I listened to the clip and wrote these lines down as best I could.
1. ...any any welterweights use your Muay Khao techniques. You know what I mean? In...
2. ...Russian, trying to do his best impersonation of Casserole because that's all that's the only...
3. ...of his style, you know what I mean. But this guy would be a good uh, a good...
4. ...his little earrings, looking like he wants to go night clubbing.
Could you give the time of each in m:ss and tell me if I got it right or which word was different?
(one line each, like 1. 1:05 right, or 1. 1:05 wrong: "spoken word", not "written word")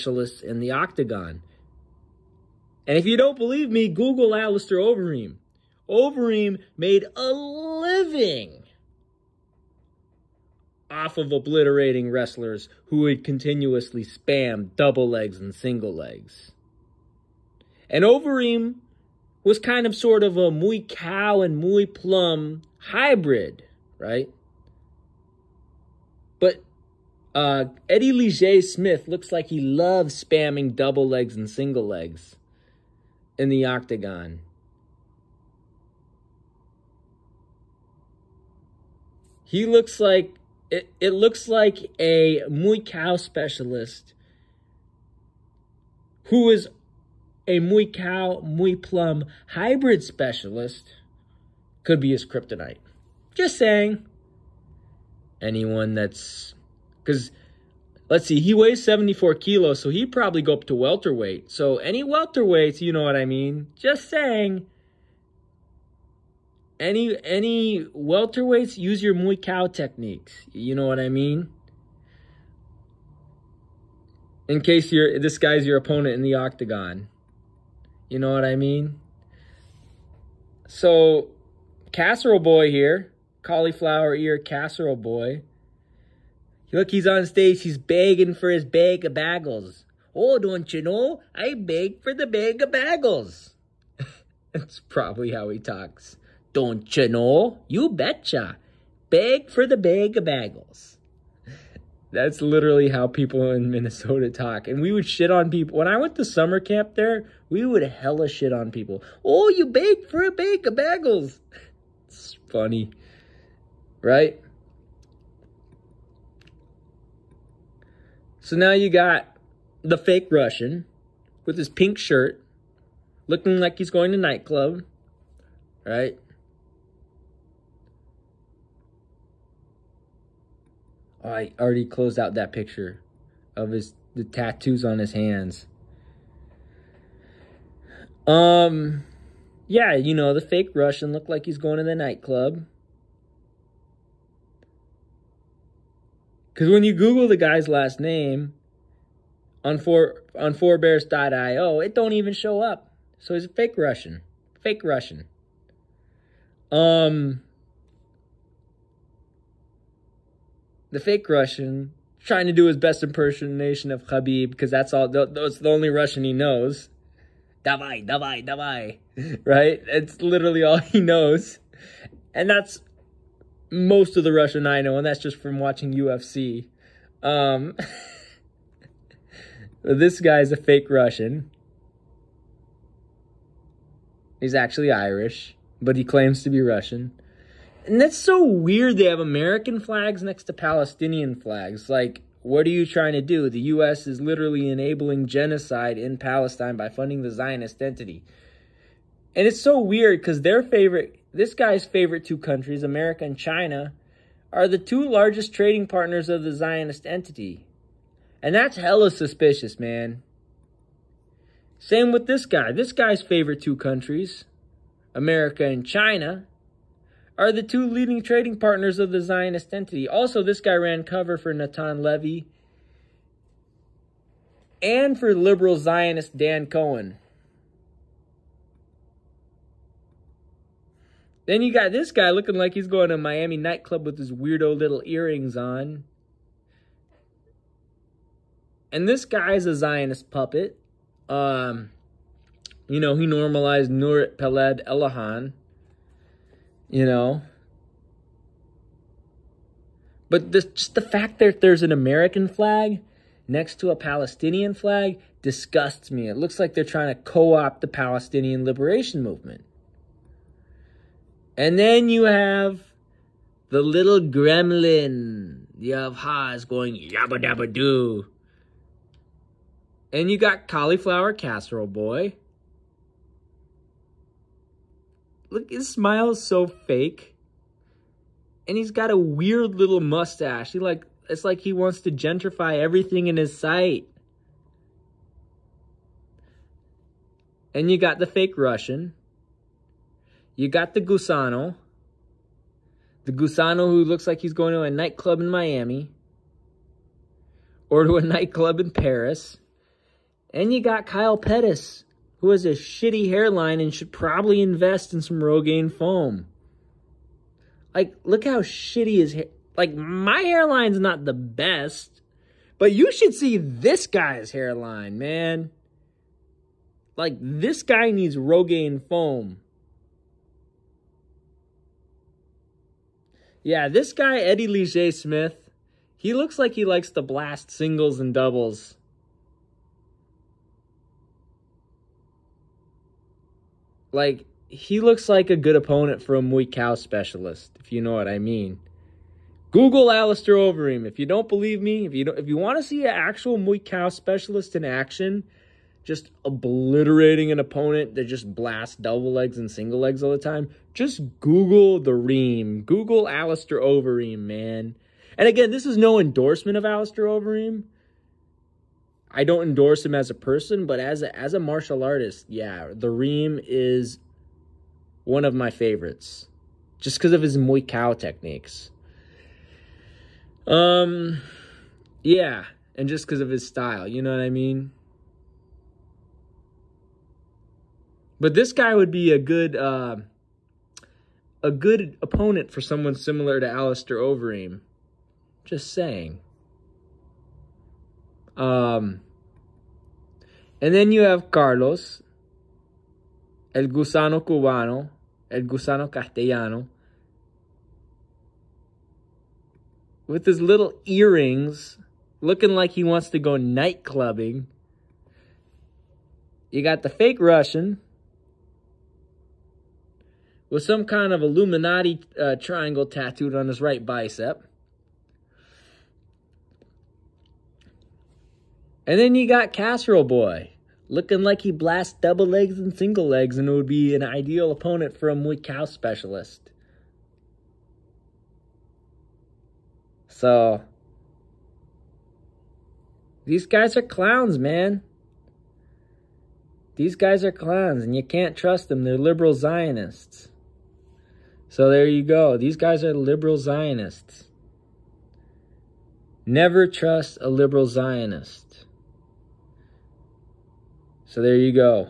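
1. 1:06 right
2. 2:41 wrong: "Khabib", not "Casserole"
3. 6:13 right
4. 6:40 right.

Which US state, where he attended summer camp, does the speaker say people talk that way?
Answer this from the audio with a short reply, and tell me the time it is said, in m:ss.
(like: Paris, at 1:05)
Minnesota, at 1:43.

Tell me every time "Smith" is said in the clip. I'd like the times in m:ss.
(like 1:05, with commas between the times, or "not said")
0:28, 5:25.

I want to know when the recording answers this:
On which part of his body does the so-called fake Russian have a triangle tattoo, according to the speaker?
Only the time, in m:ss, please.
6:53.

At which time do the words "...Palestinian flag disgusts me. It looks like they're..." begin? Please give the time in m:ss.
4:13.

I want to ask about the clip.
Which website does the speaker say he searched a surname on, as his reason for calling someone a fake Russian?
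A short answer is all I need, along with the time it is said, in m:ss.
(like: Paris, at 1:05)
forebears.io, at 2:30.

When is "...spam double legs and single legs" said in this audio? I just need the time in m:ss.
0:14.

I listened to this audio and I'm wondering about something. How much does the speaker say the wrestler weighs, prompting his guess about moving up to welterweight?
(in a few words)
74 kilos.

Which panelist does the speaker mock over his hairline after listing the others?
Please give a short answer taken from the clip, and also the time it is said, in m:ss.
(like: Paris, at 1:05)
Kyle Pettis, at 5:01.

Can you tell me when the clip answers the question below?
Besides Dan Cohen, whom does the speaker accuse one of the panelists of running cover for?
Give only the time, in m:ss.
3:41.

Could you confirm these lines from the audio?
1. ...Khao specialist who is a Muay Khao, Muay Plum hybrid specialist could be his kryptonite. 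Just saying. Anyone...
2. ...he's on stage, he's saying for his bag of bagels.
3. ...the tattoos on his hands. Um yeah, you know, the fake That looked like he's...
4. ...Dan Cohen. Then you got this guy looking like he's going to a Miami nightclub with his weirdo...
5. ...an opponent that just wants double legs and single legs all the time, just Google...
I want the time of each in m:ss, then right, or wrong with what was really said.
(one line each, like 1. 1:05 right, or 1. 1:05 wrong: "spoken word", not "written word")
1. 0:42 right
2. 1:26 wrong: "begging", not "saying"
3. 2:14 wrong: "Russian", not "That"
4. 3:46 right
5. 5:47 wrong: "blasts", not "wants".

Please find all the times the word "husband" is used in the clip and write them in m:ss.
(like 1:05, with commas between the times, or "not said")
not said.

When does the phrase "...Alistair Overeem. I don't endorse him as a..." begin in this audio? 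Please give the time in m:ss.
5:56.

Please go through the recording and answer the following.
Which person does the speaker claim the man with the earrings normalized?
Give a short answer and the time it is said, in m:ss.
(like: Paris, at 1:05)
Nurit Peled Elhanan, at 4:03.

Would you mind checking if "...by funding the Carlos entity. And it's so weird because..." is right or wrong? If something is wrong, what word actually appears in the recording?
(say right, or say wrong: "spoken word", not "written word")
wrong: "Zionist", not "Carlos".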